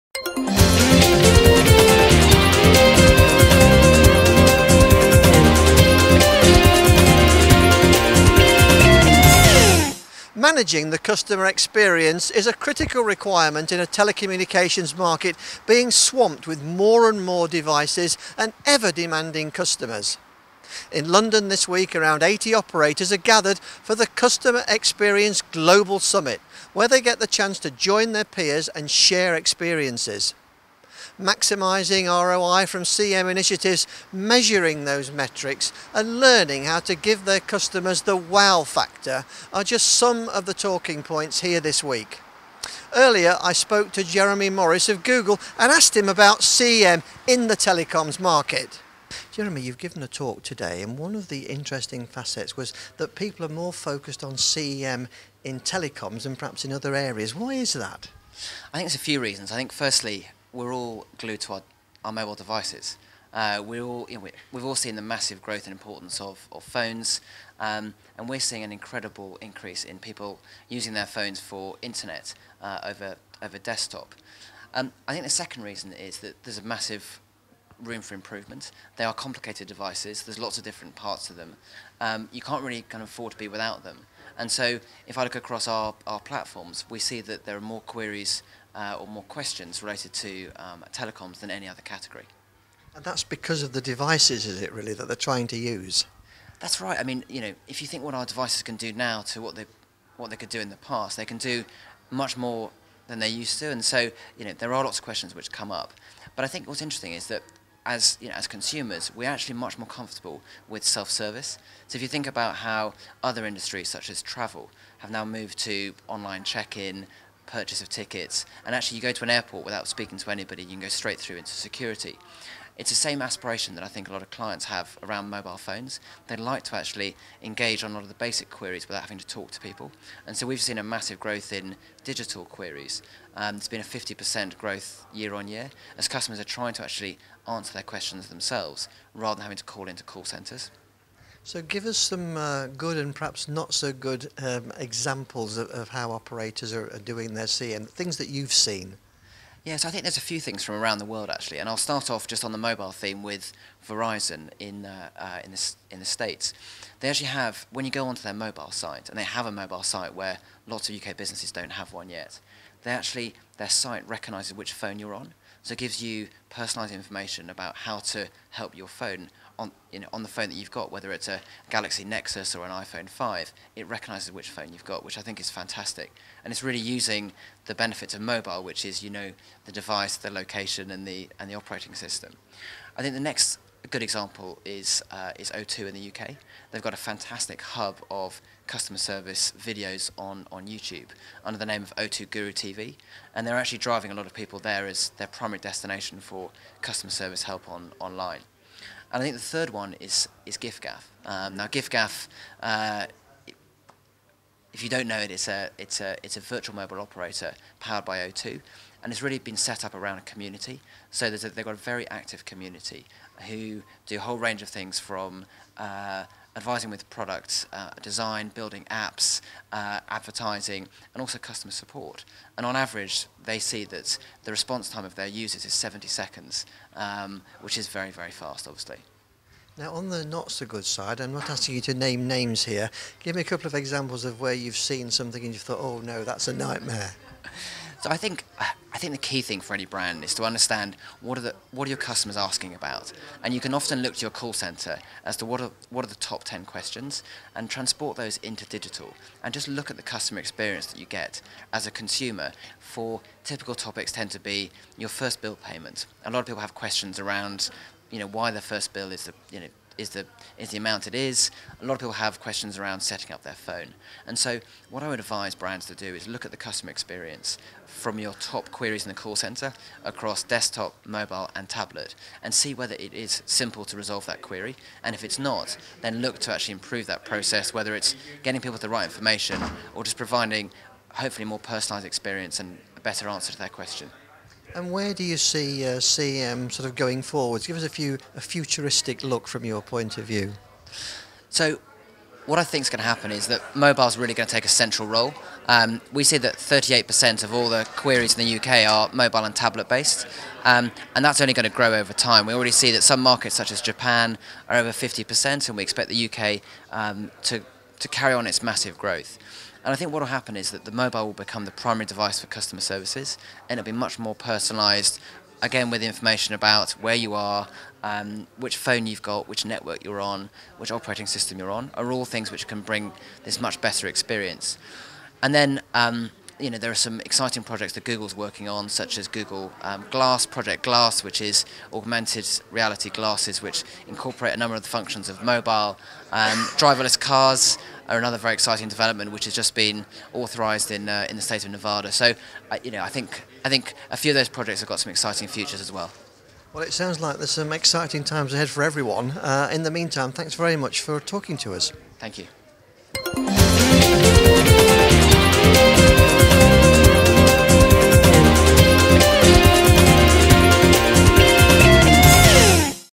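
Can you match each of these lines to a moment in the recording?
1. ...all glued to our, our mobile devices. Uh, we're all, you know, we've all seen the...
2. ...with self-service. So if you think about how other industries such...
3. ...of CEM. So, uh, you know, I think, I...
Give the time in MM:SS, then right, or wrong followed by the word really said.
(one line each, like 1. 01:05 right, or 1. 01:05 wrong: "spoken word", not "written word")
1. 01:00 right
2. 01:50 right
3. 05:41 wrong: "Nevada", not "CEM".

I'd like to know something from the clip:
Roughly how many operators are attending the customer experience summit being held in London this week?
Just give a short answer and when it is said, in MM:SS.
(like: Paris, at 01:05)
80, at 00:22.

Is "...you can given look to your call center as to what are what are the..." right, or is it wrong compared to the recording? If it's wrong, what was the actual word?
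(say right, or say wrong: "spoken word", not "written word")
wrong: "often", not "given".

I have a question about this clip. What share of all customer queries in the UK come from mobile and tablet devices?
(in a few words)
38%.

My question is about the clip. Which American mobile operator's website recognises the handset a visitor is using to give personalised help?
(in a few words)
Verizon.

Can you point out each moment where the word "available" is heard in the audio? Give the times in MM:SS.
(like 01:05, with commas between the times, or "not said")
not said.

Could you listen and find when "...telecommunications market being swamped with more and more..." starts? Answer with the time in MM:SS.
00:13.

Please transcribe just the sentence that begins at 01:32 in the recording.
And that's because of the devices, is it really, that they're trying to use?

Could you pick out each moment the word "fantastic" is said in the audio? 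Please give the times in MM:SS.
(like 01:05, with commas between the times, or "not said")
02:55, 03:07.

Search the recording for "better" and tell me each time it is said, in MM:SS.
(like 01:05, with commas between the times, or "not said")
04:43, 05:23.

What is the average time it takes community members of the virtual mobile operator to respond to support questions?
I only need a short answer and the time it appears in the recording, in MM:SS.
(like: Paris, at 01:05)
70 seconds, at 03:45.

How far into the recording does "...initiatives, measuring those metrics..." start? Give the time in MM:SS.
00:33.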